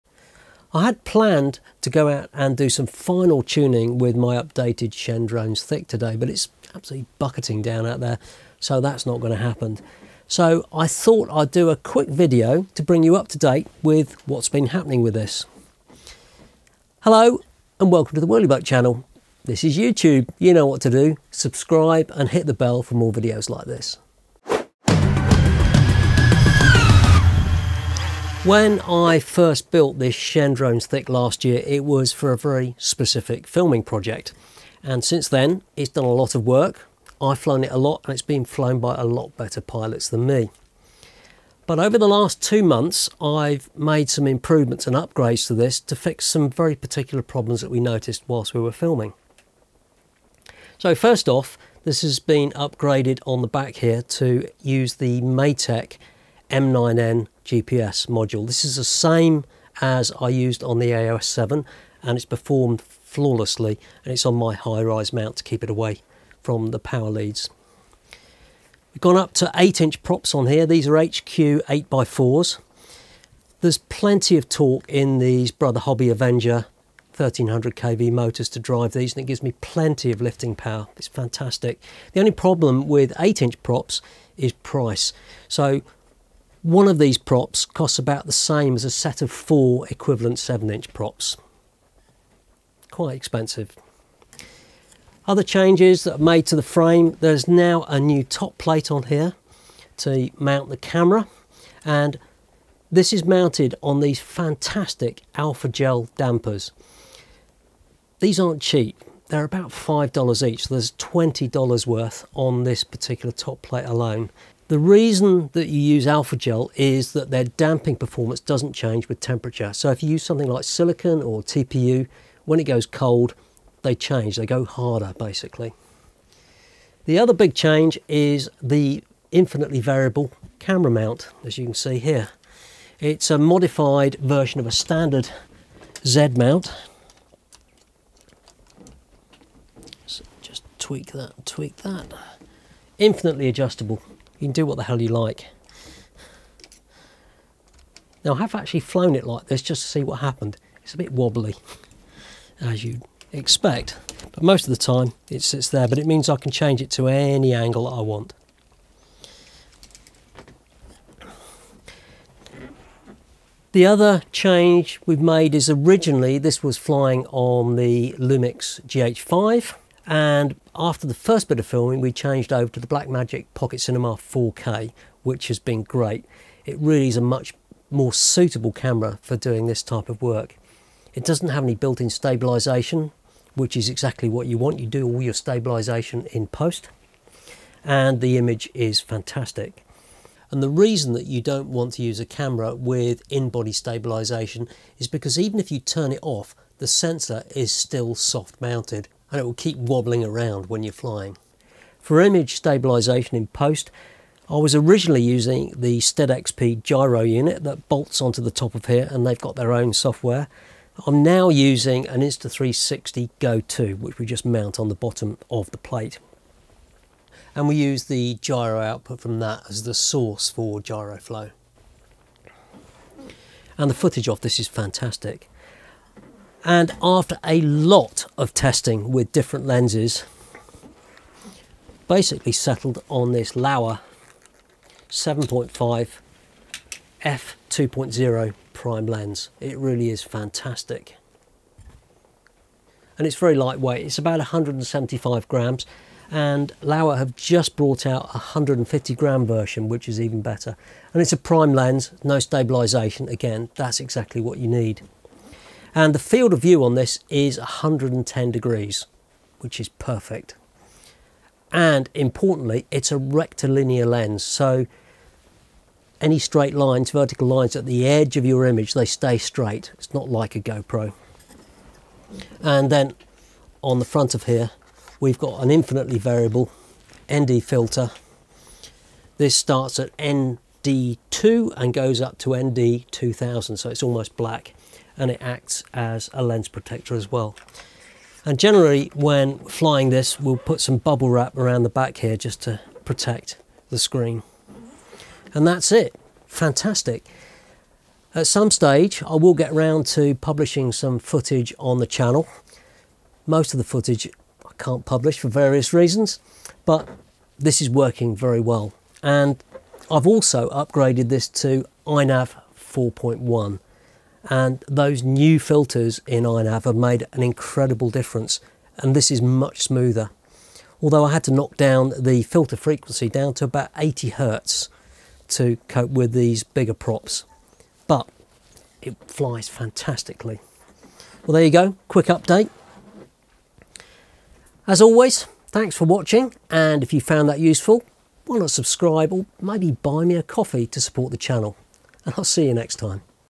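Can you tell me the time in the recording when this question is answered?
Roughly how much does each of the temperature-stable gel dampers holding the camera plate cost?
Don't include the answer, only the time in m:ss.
1:49.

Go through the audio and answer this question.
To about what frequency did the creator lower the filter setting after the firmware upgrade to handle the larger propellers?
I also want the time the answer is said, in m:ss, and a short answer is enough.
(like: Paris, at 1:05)
80 Hz, at 5:23.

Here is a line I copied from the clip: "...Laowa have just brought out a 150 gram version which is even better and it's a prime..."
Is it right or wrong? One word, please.
right.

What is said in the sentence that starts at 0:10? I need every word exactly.
So I thought I'd do a quick video to bring you up to date with what's been happening with this.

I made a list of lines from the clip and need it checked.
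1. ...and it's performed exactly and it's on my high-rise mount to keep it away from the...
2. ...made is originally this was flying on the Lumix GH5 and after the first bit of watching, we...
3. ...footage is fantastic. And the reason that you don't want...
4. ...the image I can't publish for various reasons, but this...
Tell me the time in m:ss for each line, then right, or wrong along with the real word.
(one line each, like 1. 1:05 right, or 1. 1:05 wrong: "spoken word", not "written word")
1. 1:02 wrong: "flawlessly", not "exactly"
2. 2:45 wrong: "filming", not "watching"
3. 3:08 wrong: "image", not "footage"
4. 5:03 wrong: "footage", not "image".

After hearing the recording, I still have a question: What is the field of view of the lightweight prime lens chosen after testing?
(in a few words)
110 degrees.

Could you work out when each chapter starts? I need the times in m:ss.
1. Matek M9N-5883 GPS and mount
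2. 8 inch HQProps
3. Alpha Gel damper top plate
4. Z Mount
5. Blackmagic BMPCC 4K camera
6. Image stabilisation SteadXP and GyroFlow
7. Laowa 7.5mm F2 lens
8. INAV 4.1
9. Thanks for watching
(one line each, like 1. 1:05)
1. 0:50
2. 1:08
3. 1:43
4. 2:05
5. 2:40
6. 3:22
7. 3:45
8. 5:05
9. 5:30.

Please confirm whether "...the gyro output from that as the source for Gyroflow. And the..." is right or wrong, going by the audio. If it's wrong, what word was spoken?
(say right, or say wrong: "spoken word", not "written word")
right.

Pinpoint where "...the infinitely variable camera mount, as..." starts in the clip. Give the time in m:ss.
2:08.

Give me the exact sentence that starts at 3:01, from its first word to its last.
It doesn't have any built-in stabilization, which is exactly what you want.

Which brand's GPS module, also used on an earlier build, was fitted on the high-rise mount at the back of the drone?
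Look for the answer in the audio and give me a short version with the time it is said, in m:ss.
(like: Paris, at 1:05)
Matek M9N, at 0:55.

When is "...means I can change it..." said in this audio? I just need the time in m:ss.
2:36.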